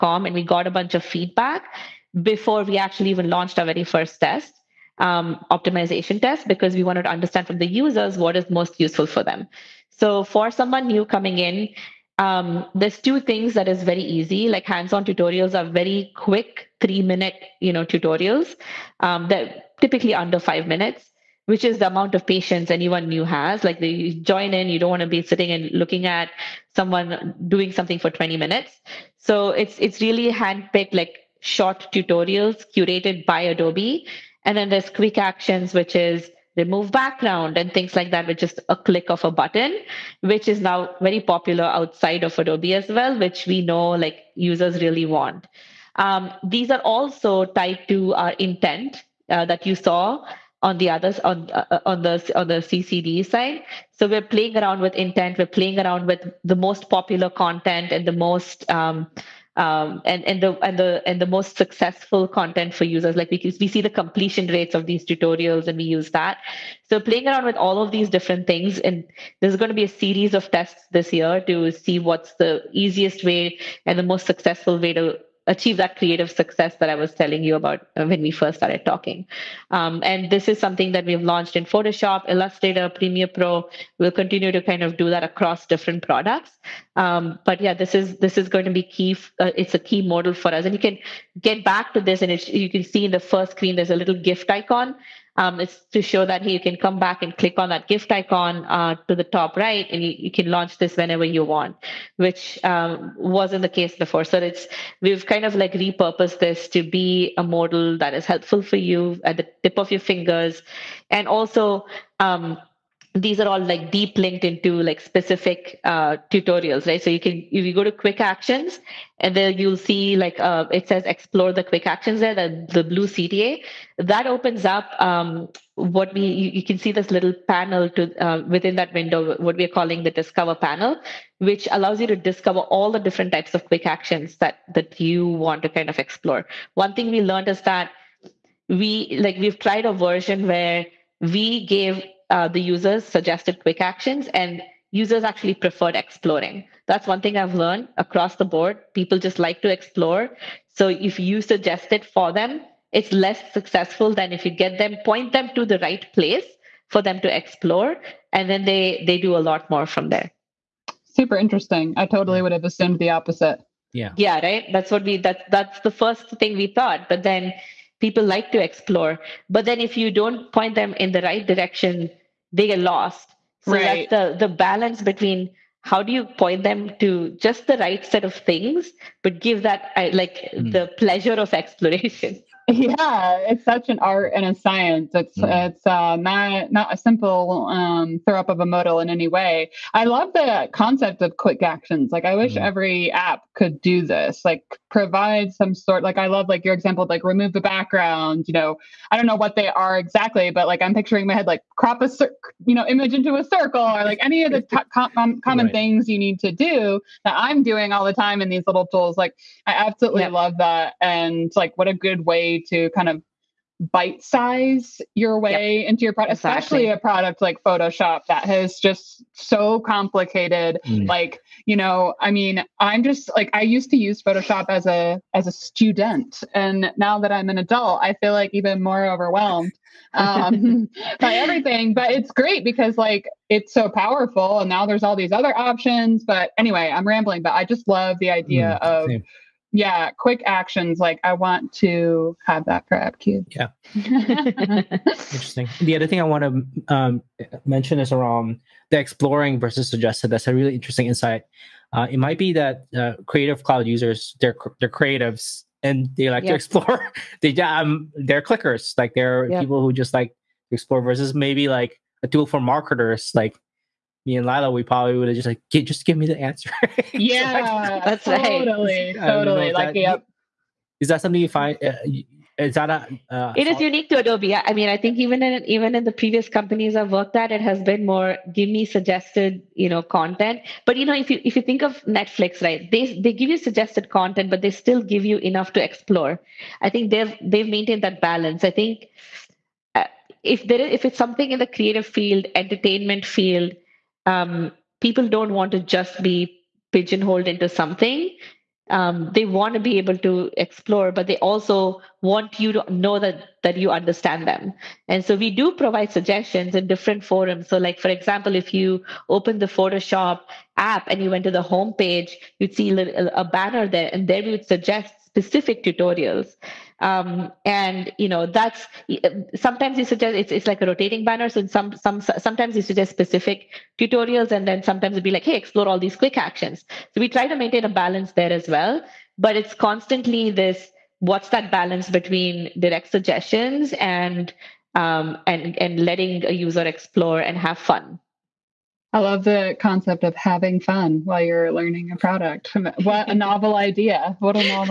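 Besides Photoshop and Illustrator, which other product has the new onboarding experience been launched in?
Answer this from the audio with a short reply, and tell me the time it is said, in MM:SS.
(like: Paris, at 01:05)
Premiere Pro, at 01:22.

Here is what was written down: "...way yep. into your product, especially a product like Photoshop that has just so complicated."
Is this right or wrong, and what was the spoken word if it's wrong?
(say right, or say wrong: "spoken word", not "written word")
right.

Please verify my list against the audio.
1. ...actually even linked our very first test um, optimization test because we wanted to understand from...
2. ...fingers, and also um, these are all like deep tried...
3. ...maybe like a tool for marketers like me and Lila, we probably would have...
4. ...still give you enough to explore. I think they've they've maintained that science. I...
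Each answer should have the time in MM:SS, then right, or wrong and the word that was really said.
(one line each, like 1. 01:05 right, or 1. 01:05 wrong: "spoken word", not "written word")
1. 00:02 wrong: "launched", not "linked"
2. 01:49 wrong: "linked", not "tried"
3. 04:21 right
4. 04:44 wrong: "balance", not "science".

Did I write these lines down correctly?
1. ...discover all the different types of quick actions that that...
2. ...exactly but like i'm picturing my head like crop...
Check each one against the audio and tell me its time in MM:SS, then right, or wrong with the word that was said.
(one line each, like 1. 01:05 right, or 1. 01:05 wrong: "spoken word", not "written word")
1. 02:12 right
2. 03:19 right.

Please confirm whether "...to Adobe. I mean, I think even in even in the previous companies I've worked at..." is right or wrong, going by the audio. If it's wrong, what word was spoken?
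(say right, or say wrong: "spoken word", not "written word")
right.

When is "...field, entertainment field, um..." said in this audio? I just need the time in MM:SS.
04:52.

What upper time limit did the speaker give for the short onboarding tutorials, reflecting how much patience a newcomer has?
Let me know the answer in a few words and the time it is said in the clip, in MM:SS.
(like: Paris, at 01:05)
5 minutes, at 00:20.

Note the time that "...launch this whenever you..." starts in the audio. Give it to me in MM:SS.
01:40.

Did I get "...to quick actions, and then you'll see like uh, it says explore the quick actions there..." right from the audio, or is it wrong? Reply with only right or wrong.
right.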